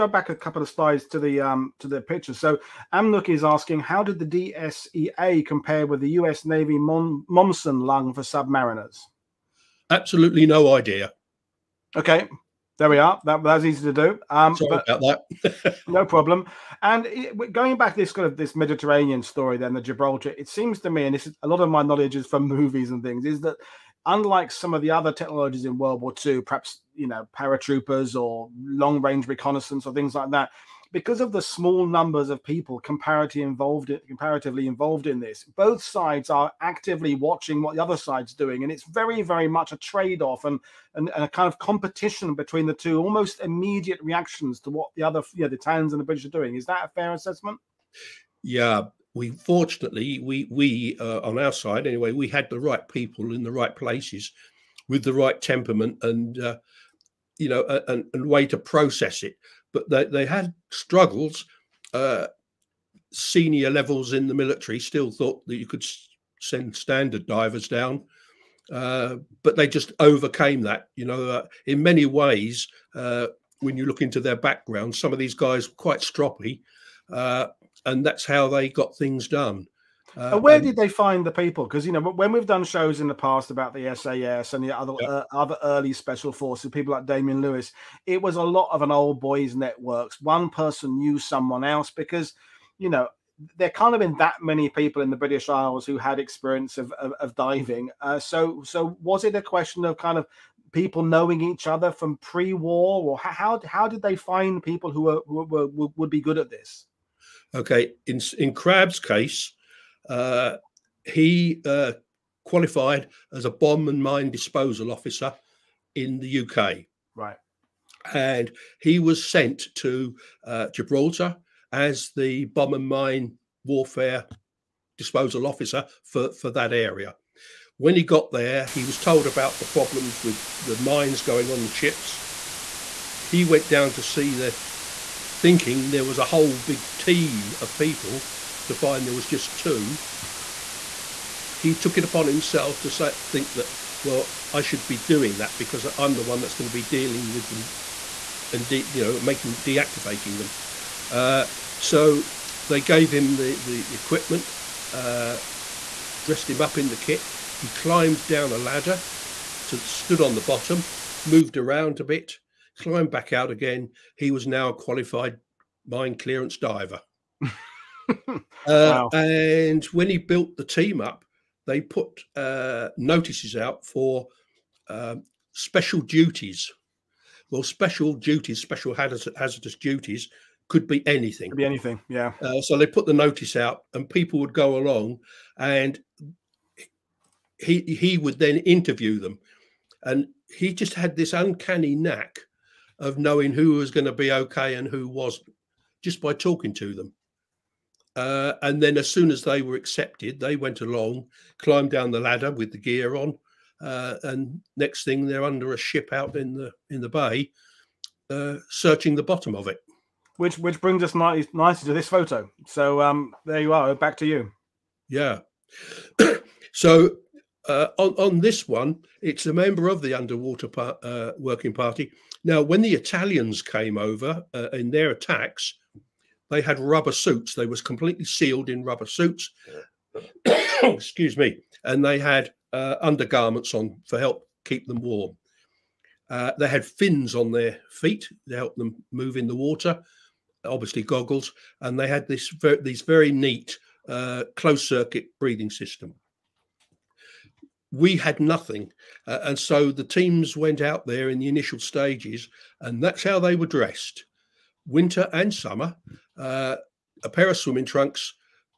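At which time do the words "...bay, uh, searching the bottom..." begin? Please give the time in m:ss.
3:27.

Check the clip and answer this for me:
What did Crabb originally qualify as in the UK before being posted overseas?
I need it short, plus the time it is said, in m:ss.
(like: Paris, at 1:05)
Bomb and mine disposal officer, at 1:53.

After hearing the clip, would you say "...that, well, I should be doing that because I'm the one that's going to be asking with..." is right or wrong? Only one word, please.
wrong.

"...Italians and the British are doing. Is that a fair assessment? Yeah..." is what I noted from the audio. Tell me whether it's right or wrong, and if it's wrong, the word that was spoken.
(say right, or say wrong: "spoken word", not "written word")
right.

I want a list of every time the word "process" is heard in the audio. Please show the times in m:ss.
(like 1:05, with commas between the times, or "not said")
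0:58.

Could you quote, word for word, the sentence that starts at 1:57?
Right, and he was sent to uh, Gibraltar as the bomb and mine warfare disposal officer for for that area.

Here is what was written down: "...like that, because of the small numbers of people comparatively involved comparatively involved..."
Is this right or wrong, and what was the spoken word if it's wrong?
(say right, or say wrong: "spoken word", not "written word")
right.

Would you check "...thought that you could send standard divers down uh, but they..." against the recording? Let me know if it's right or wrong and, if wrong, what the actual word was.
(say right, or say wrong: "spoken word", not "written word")
right.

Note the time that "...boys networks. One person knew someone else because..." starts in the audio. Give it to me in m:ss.
1:29.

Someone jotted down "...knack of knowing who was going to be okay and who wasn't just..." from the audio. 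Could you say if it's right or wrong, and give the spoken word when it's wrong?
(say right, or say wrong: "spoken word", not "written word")
right.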